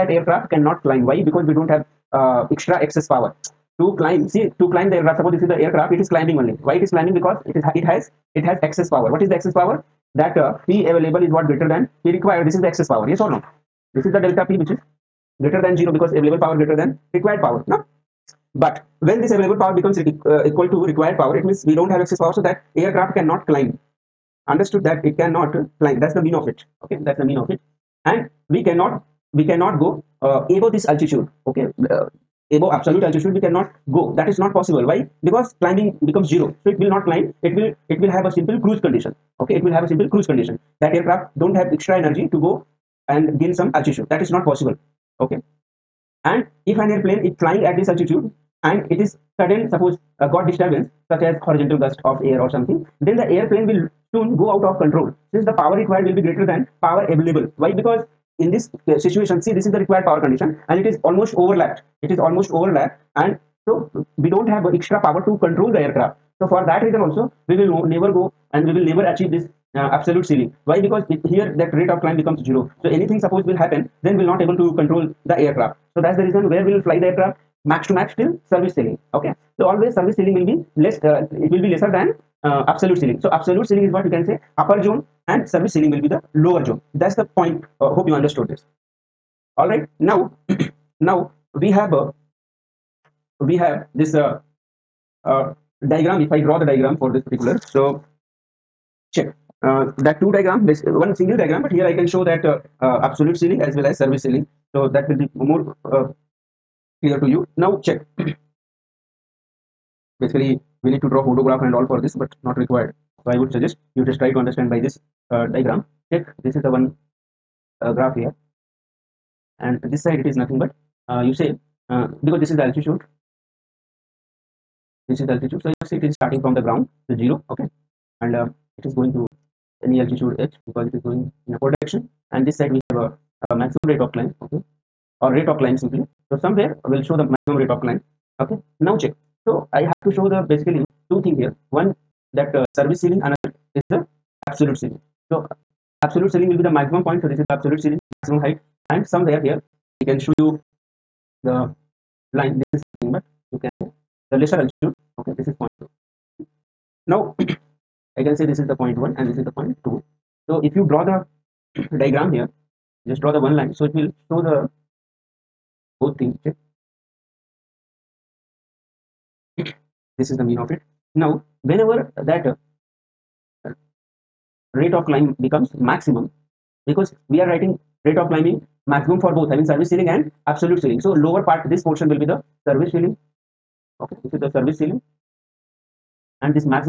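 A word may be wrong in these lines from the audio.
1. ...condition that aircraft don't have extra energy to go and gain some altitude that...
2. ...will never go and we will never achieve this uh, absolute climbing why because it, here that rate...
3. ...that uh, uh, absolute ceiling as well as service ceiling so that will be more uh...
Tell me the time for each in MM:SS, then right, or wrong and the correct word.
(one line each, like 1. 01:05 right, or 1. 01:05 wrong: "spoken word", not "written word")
1. 00:40 right
2. 01:07 wrong: "ceiling", not "climbing"
3. 01:42 right.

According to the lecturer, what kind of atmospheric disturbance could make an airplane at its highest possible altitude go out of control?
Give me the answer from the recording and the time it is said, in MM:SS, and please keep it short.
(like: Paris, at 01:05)
horizontal gust of air, at 00:51.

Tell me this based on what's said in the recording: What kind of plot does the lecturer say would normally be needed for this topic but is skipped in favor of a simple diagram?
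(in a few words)
hodograph.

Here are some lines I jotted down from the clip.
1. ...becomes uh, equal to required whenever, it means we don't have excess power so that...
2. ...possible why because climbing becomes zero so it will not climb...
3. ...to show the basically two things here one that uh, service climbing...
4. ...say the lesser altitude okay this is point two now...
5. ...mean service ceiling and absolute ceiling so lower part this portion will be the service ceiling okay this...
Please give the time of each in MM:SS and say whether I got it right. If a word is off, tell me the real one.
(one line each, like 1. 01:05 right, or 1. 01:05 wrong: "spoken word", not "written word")
1. 00:19 wrong: "power", not "whenever"
2. 00:34 right
3. 02:20 wrong: "ceiling", not "climbing"
4. 02:33 right
5. 02:59 right.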